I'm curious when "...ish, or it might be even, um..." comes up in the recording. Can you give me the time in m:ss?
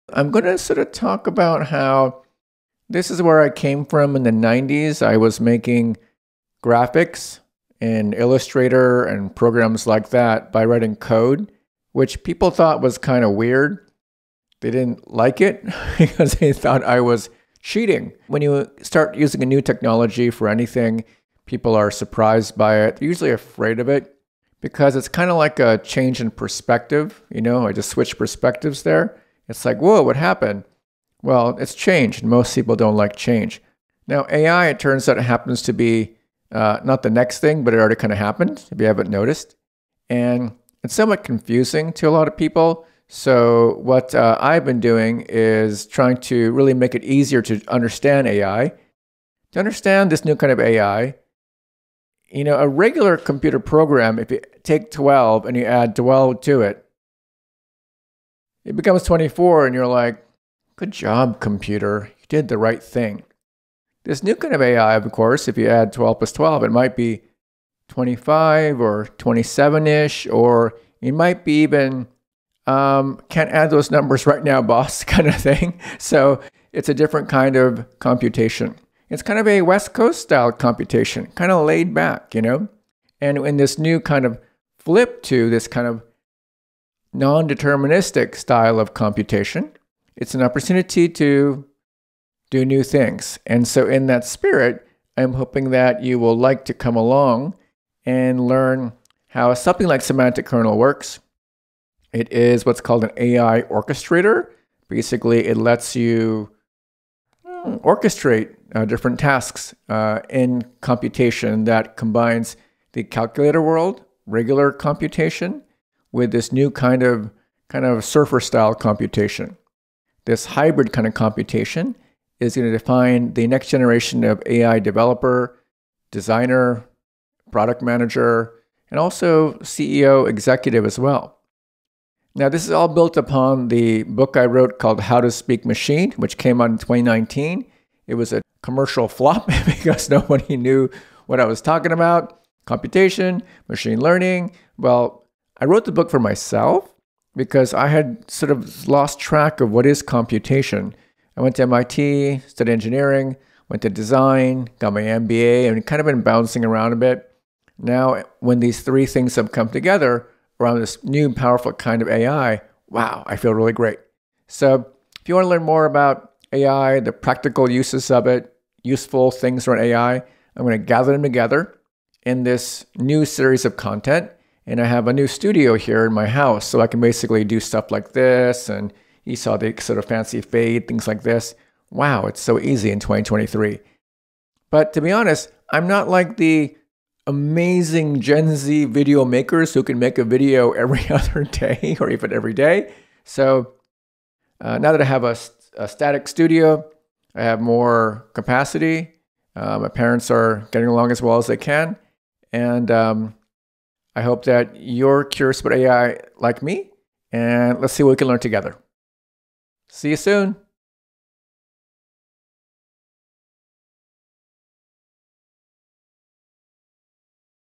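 1:09.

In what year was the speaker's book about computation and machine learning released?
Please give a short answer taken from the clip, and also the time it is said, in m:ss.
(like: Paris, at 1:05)
2019, at 2:16.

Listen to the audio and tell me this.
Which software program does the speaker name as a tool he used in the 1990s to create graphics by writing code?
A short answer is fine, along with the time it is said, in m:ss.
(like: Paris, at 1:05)
Illustrator, at 0:08.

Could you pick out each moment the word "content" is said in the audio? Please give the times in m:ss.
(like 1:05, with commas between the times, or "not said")
2:53.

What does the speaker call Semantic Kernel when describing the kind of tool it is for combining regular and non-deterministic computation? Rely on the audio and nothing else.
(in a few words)
AI orchestrator.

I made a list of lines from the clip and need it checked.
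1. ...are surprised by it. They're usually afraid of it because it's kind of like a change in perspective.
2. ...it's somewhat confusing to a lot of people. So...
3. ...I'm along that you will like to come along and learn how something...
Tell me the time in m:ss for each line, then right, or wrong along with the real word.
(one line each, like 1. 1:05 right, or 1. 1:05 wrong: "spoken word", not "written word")
1. 0:21 right
2. 0:40 right
3. 1:35 wrong: "hoping", not "along".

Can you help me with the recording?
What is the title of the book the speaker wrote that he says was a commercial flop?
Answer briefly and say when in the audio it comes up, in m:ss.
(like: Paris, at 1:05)
How to Speak Machine, at 2:15.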